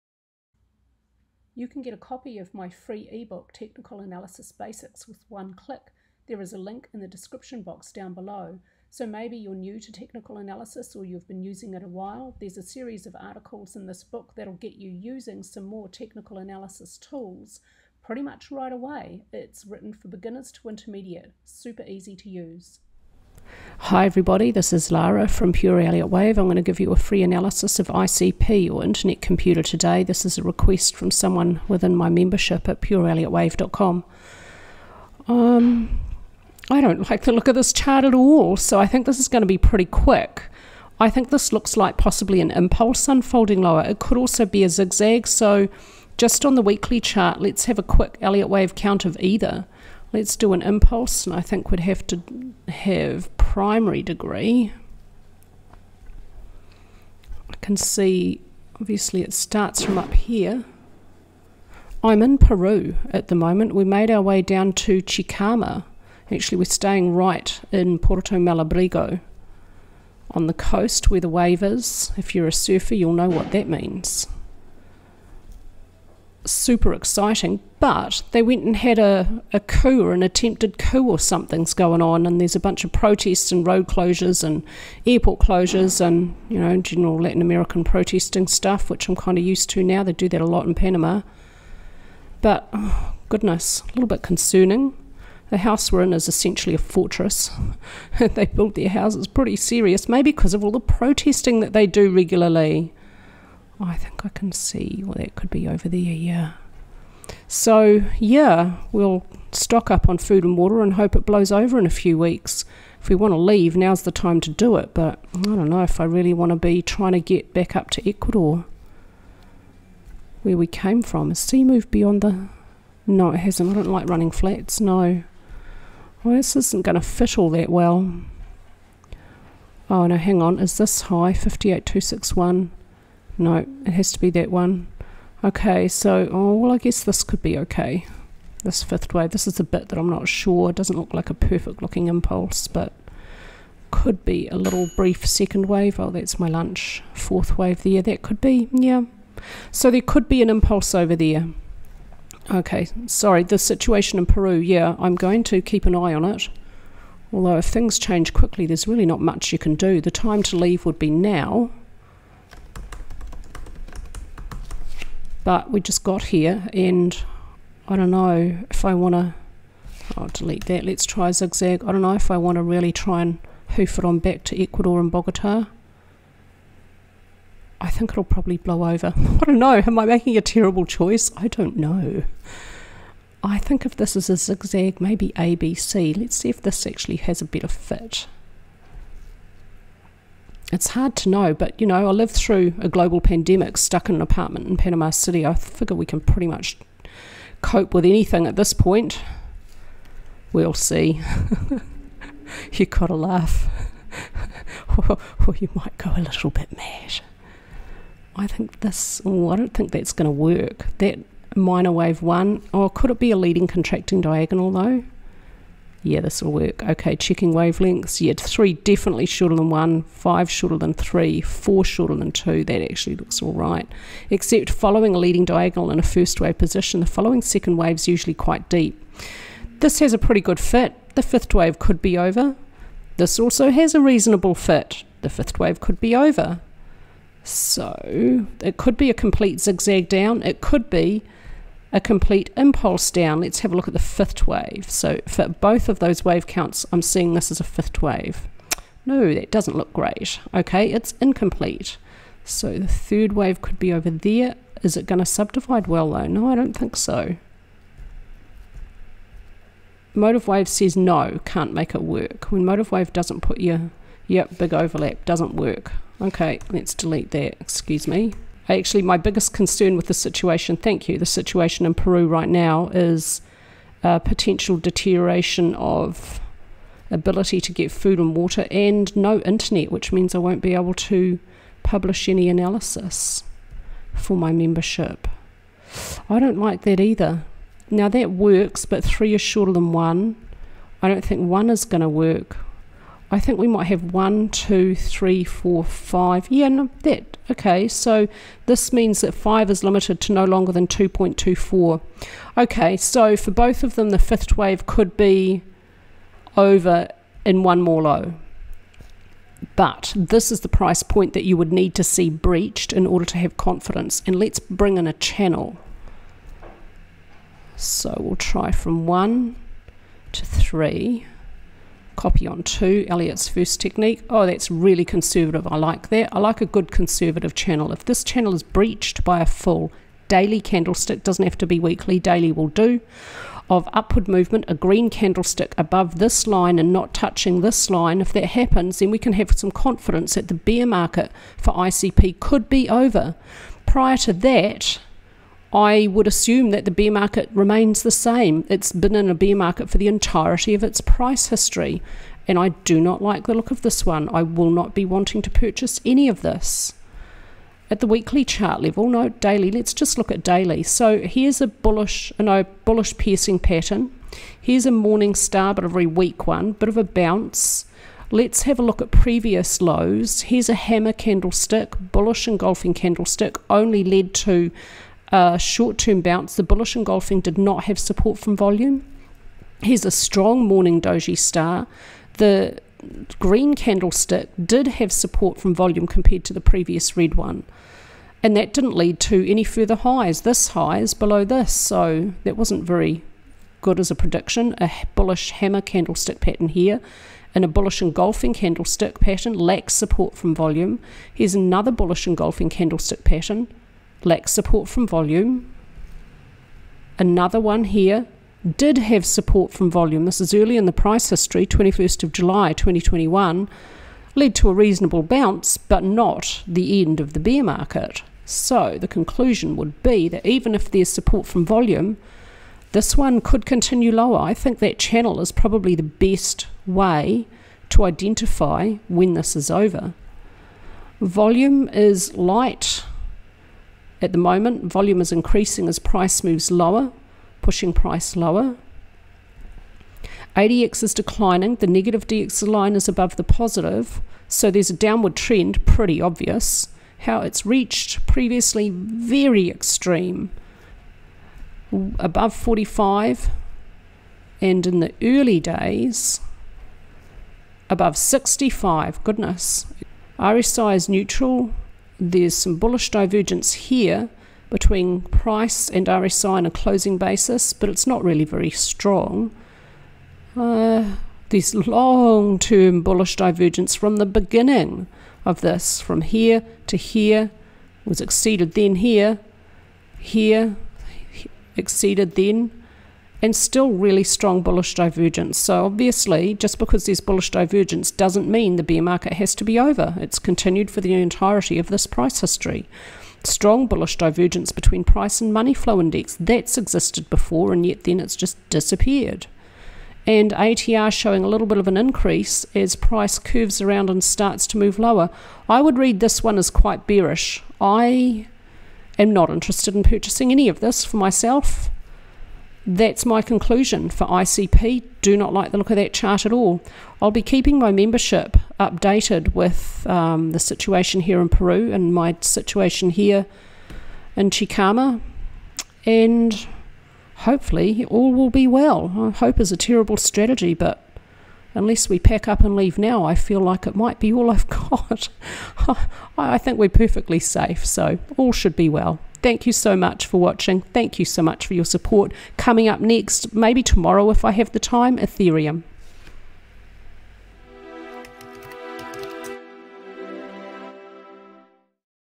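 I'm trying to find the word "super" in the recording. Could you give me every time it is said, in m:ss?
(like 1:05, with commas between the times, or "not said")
0:21, 1:16.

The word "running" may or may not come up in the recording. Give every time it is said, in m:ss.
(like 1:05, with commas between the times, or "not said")
2:04.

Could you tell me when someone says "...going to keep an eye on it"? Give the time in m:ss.
2:35.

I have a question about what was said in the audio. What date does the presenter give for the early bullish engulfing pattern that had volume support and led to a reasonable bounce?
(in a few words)
21 July 2021.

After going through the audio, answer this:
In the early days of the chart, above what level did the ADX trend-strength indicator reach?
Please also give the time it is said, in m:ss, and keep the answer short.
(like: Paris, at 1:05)
65, at 7:38.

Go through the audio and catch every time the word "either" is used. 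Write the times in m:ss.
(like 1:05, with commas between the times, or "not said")
0:49, 4:46.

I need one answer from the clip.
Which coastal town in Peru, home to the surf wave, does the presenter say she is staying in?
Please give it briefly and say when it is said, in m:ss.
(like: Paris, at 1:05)
Puerto Malabrigo, at 1:07.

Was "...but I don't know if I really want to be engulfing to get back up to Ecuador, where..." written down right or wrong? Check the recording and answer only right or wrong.
wrong.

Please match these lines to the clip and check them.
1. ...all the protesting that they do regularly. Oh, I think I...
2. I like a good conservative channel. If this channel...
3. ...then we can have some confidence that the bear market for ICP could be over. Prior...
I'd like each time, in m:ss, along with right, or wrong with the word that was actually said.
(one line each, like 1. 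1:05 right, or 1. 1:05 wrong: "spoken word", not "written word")
1. 1:40 right
2. 5:26 right
3. 5:38 right.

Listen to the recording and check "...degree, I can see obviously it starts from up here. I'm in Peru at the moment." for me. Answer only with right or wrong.
right.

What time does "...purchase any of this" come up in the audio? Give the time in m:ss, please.
5:55.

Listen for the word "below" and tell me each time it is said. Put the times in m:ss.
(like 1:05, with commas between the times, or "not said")
0:08, 6:31.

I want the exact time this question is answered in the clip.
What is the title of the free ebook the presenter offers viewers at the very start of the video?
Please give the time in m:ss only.
0:03.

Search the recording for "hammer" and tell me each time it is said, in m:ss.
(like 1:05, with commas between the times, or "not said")
6:10, 6:35.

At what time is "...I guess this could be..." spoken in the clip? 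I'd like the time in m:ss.
2:16.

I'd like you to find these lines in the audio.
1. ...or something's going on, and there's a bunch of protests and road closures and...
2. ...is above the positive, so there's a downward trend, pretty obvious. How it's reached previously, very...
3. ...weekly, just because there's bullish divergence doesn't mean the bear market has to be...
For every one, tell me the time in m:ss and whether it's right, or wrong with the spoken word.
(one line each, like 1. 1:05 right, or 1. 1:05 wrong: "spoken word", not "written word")
1. 1:21 right
2. 7:22 right
3. 8:05 wrong: "obviously", not "weekly".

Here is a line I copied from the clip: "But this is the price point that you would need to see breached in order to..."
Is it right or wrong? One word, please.
right.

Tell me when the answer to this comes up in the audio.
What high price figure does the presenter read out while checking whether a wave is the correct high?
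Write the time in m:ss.
2:11.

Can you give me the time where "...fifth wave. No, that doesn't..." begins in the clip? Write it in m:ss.
4:07.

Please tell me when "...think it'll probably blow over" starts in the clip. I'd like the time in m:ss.
2:57.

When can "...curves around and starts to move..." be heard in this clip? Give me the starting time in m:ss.
8:23.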